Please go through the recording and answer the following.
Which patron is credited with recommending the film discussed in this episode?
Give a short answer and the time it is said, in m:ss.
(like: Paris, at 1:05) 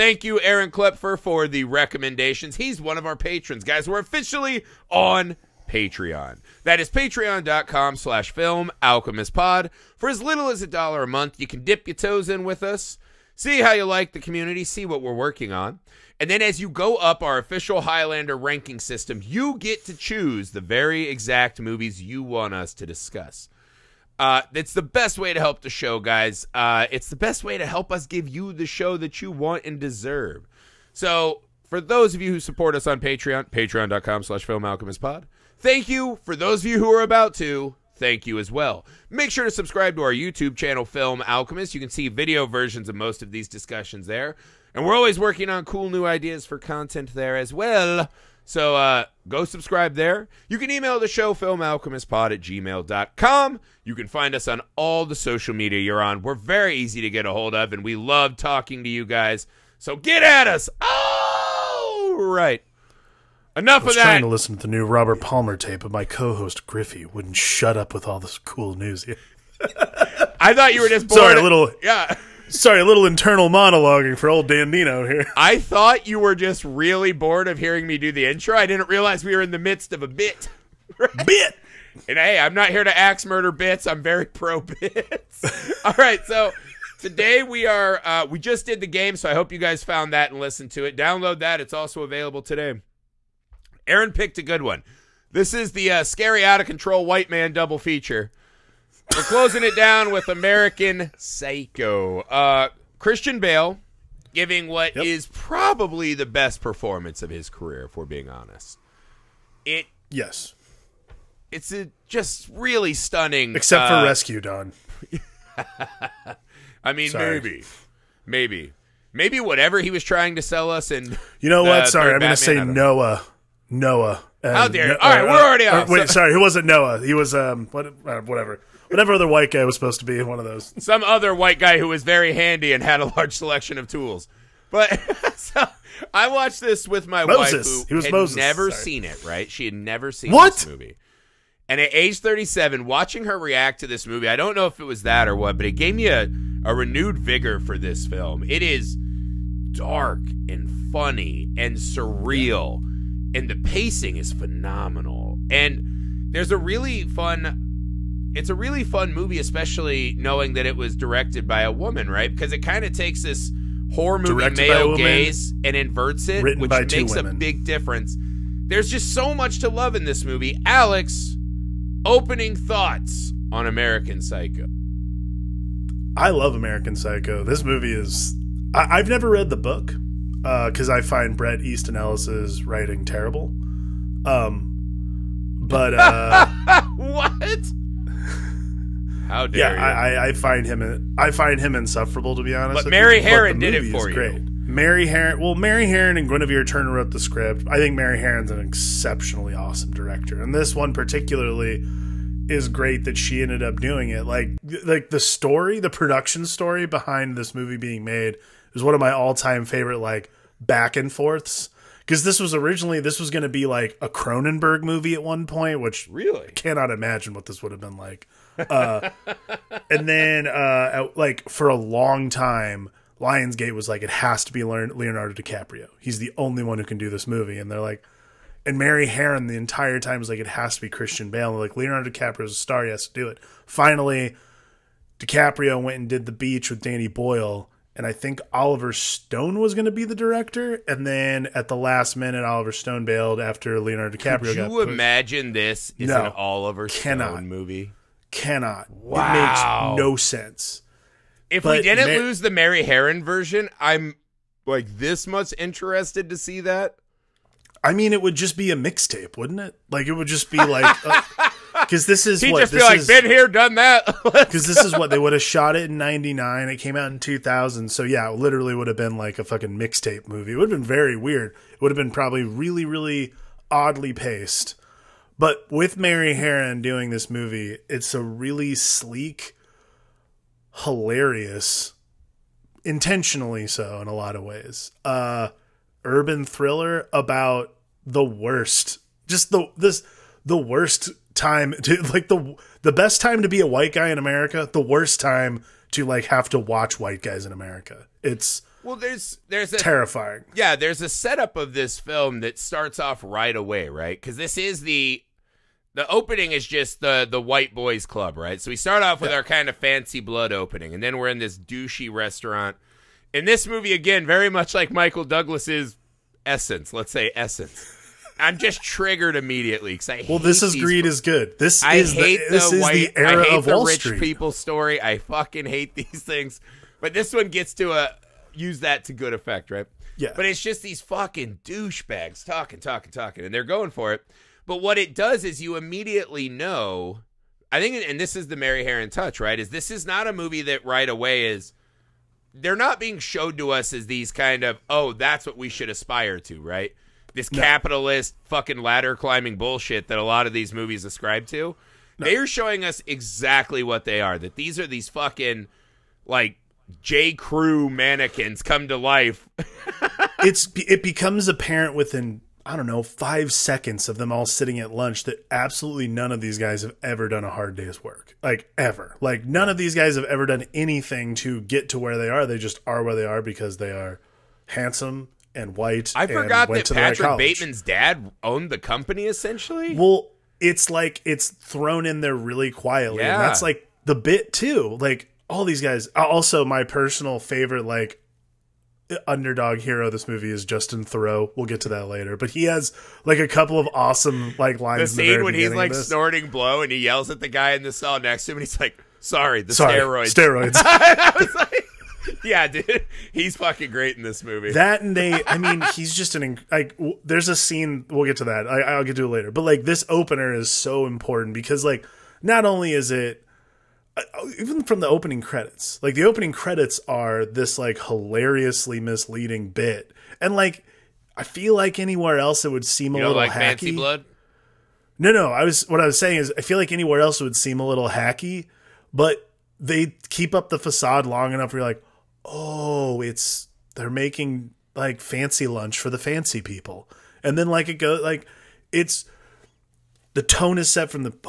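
Aaron Klepfer, at 0:00.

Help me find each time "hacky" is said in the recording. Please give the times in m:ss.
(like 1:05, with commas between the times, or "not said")
7:03, 7:08.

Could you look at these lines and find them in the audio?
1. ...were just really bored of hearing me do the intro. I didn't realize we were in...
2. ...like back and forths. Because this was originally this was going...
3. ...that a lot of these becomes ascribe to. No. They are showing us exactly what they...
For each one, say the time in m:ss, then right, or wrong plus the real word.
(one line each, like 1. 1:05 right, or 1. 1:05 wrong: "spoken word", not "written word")
1. 1:16 right
2. 3:29 right
3. 5:50 wrong: "movies", not "becomes".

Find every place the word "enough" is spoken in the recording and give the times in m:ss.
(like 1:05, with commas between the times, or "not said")
1:03, 7:11.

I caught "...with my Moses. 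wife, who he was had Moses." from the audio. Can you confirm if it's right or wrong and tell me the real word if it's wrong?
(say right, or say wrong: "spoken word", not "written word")
right.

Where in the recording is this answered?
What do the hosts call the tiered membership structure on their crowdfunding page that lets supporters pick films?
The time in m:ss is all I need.
0:17.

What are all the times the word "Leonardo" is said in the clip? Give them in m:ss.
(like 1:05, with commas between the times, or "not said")
3:44, 3:51, 4:03.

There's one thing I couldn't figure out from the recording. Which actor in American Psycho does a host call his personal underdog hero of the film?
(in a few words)
Justin Theroux.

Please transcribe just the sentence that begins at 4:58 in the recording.
It's well, there's there's a, terrifying.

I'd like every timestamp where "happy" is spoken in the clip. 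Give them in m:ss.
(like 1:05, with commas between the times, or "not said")
not said.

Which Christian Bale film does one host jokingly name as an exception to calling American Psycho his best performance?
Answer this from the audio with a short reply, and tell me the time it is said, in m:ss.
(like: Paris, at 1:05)
Rescue Dawn, at 1:54.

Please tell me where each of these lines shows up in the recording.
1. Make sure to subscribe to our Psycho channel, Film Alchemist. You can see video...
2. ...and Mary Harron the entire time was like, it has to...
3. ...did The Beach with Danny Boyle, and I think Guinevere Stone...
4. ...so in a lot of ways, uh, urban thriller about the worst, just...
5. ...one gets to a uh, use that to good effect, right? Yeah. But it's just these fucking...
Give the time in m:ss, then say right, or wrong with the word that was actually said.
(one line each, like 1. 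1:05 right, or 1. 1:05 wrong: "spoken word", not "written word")
1. 0:39 wrong: "YouTube", not "Psycho"
2. 3:48 right
3. 3:56 wrong: "Oliver", not "Guinevere"
4. 4:43 right
5. 5:27 right.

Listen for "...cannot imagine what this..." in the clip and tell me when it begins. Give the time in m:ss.
3:36.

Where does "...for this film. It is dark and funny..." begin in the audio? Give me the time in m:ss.
2:27.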